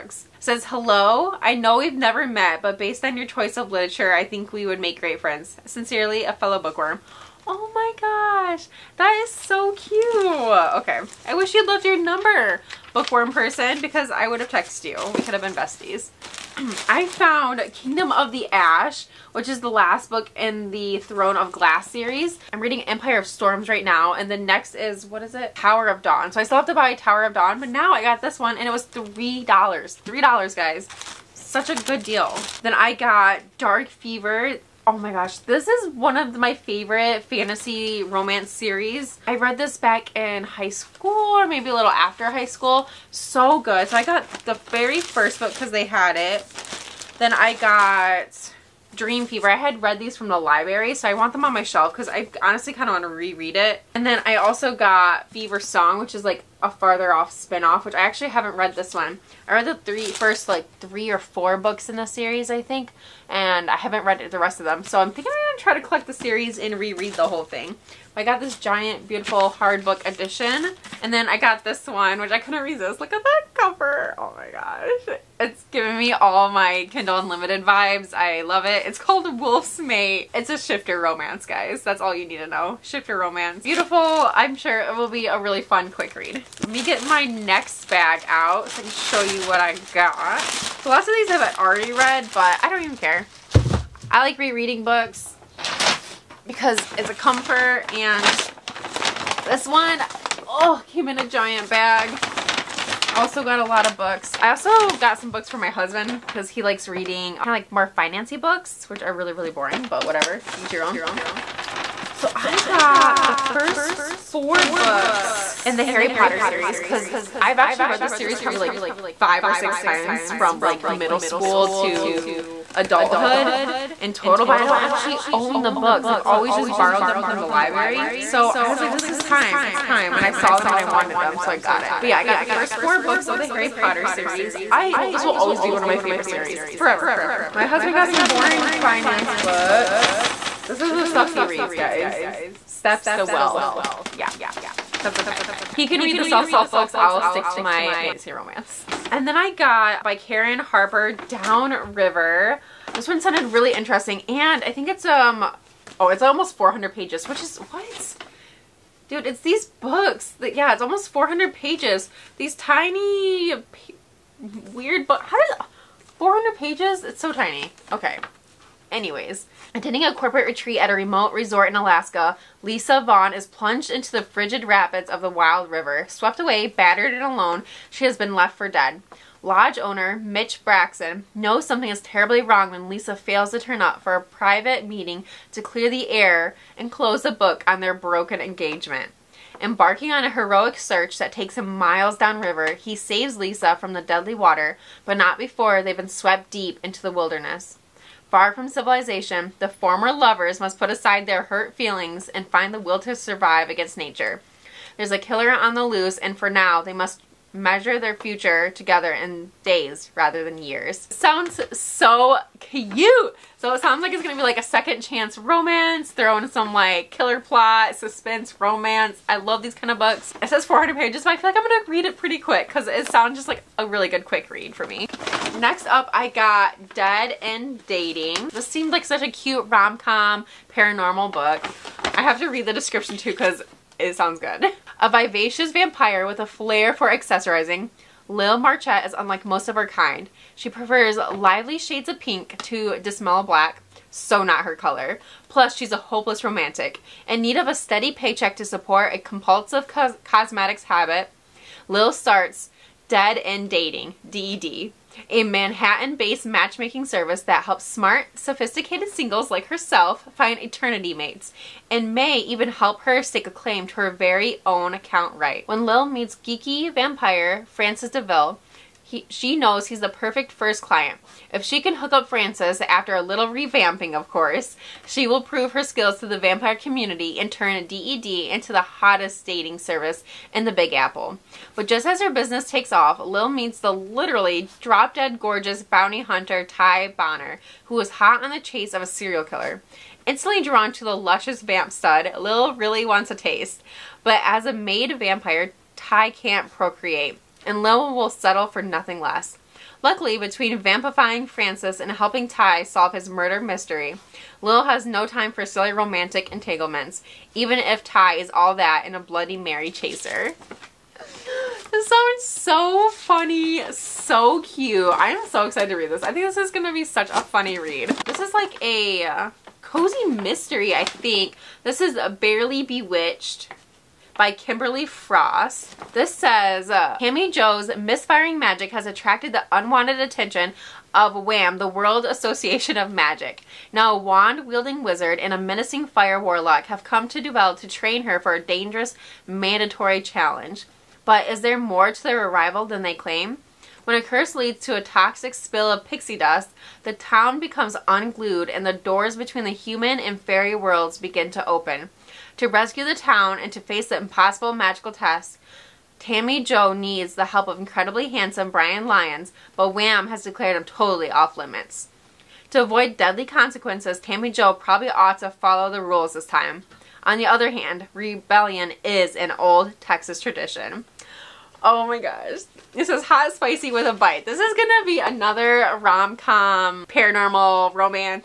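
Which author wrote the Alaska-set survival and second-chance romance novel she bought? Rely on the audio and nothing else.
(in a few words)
Karen Harper.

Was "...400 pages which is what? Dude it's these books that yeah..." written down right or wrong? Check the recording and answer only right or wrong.
right.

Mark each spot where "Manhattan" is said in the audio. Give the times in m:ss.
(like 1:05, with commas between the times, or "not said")
4:15.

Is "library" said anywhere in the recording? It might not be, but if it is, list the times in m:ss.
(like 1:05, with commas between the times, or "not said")
0:50, 2:07.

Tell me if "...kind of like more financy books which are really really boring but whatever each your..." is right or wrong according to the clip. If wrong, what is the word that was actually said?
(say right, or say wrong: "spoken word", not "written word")
right.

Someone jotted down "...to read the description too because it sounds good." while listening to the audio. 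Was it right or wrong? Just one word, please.
right.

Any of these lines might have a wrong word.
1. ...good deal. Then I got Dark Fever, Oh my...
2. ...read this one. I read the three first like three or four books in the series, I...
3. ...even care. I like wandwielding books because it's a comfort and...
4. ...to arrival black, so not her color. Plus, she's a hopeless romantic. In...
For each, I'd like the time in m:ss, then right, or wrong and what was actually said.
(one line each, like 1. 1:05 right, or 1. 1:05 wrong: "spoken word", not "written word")
1. 0:31 right
2. 0:58 right
3. 1:32 wrong: "rereading", not "wandwielding"
4. 4:02 wrong: "dismal", not "arrival".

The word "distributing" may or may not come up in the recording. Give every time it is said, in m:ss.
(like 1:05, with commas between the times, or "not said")
not said.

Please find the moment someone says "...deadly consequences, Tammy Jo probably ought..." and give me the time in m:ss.
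6:03.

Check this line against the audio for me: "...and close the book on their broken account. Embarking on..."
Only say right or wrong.
wrong.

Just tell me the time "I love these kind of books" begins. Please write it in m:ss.
3:39.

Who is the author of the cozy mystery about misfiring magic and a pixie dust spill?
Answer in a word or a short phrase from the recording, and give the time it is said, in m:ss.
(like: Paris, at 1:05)
Kimberly Frost, at 5:24.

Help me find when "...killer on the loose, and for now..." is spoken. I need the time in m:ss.
3:25.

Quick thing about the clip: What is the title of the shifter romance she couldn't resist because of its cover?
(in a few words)
Wolf's Mate.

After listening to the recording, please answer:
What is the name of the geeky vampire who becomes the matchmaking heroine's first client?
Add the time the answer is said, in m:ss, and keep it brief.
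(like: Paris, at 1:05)
Francis DeVille, at 4:27.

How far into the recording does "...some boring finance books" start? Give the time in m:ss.
2:18.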